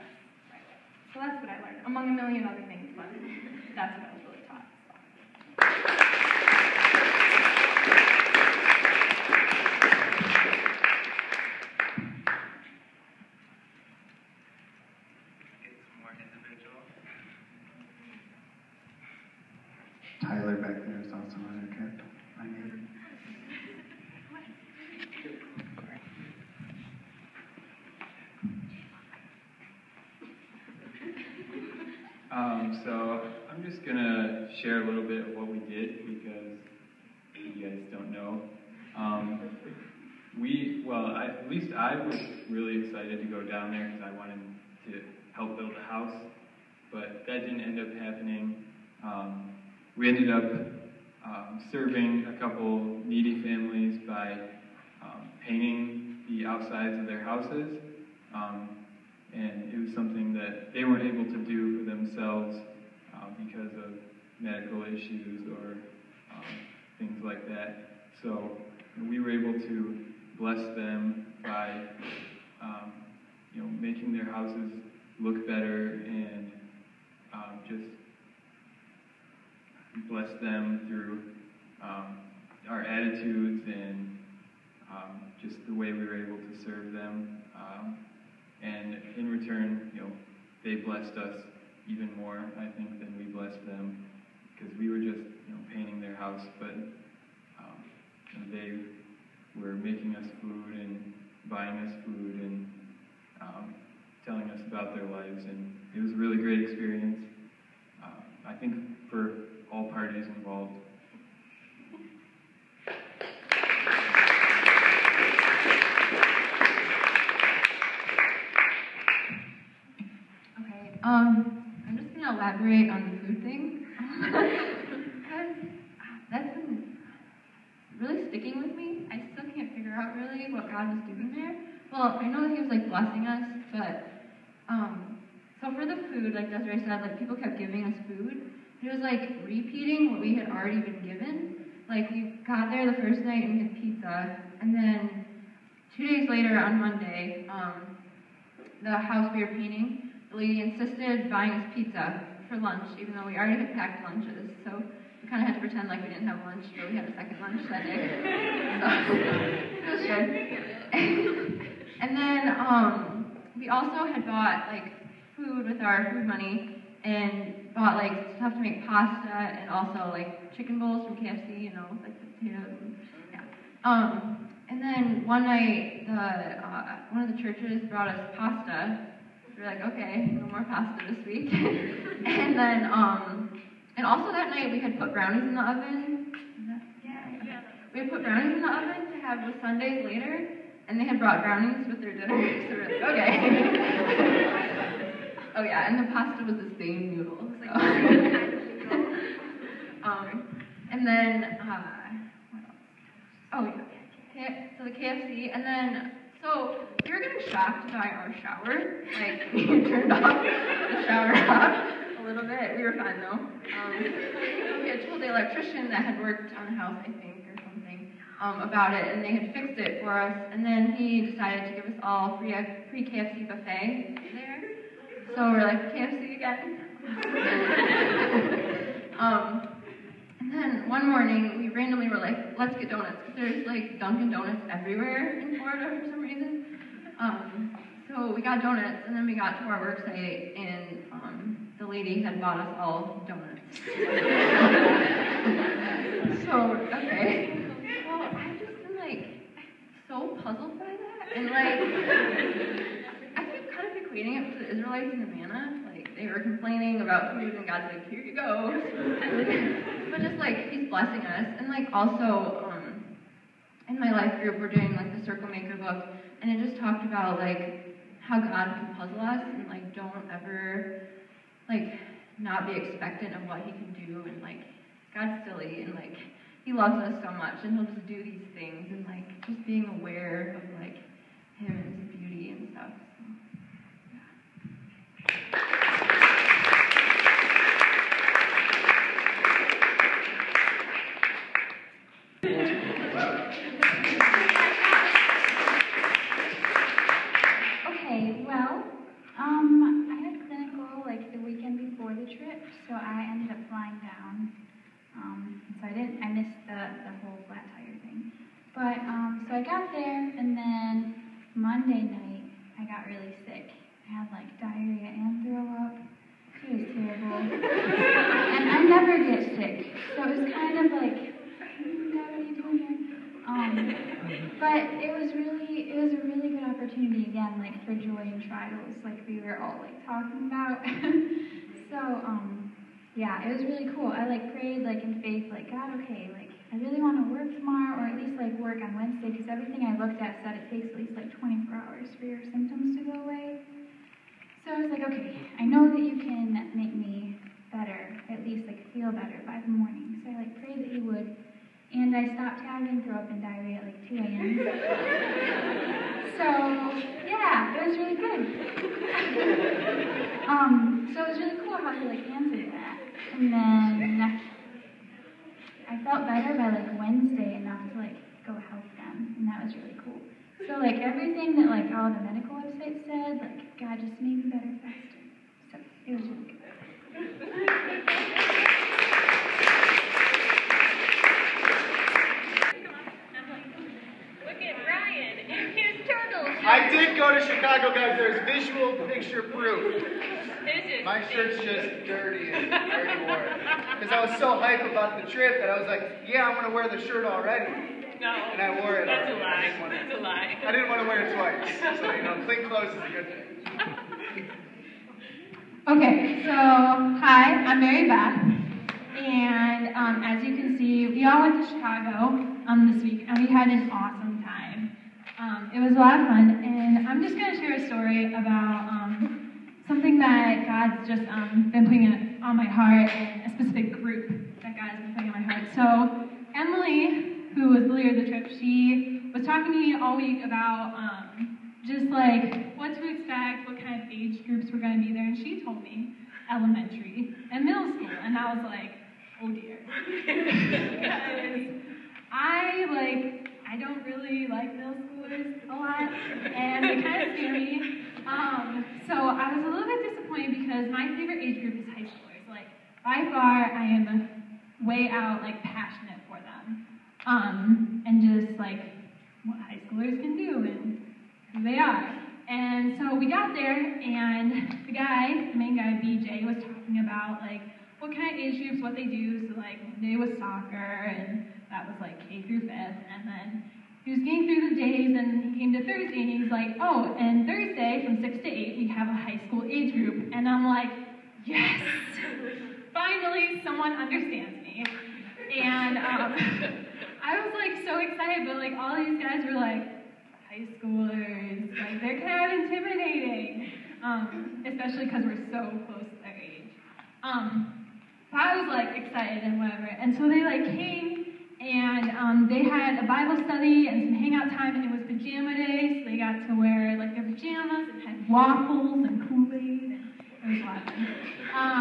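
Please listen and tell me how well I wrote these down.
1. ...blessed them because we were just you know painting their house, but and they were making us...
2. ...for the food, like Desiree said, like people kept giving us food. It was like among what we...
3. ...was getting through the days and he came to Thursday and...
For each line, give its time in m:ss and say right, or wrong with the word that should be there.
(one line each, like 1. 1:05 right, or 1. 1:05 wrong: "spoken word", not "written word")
1. 1:33 right
2. 2:15 wrong: "repeating", not "among"
3. 7:54 right.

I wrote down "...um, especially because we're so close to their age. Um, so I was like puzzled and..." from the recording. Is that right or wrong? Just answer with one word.
wrong.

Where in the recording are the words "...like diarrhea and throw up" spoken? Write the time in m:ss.
5:14.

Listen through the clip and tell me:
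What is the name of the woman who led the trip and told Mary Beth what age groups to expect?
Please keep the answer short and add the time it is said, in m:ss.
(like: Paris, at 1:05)
Emily, at 7:06.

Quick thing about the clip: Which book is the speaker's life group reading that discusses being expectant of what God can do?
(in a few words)
The Circle Maker.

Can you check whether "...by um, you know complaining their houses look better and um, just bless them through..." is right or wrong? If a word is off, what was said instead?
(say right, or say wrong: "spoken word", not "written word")
wrong: "making", not "complaining".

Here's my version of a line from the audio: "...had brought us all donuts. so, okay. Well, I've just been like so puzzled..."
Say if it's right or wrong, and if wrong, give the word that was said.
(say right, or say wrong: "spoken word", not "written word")
wrong: "bought", not "brought".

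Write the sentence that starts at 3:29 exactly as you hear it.
Like we turned off the shower off little bit.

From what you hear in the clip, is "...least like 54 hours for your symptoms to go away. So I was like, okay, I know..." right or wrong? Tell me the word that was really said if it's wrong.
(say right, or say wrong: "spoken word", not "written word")
wrong: "24", not "54".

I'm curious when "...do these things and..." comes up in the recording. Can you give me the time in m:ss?
4:38.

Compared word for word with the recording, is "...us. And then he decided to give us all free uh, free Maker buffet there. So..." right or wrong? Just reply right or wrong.
wrong.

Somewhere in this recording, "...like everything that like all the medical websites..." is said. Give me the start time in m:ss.
6:10.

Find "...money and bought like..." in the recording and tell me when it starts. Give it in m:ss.
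2:46.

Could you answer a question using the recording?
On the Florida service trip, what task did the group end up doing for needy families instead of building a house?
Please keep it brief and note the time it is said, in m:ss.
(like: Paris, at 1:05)
Painting the outsides of their houses, at 0:55.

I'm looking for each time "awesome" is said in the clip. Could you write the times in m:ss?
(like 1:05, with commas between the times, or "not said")
6:53, 8:30.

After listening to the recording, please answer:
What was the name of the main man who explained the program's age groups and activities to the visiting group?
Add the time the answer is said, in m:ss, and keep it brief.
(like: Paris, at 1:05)
BJ, at 7:46.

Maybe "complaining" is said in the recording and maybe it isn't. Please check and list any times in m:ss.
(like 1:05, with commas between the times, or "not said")
4:16.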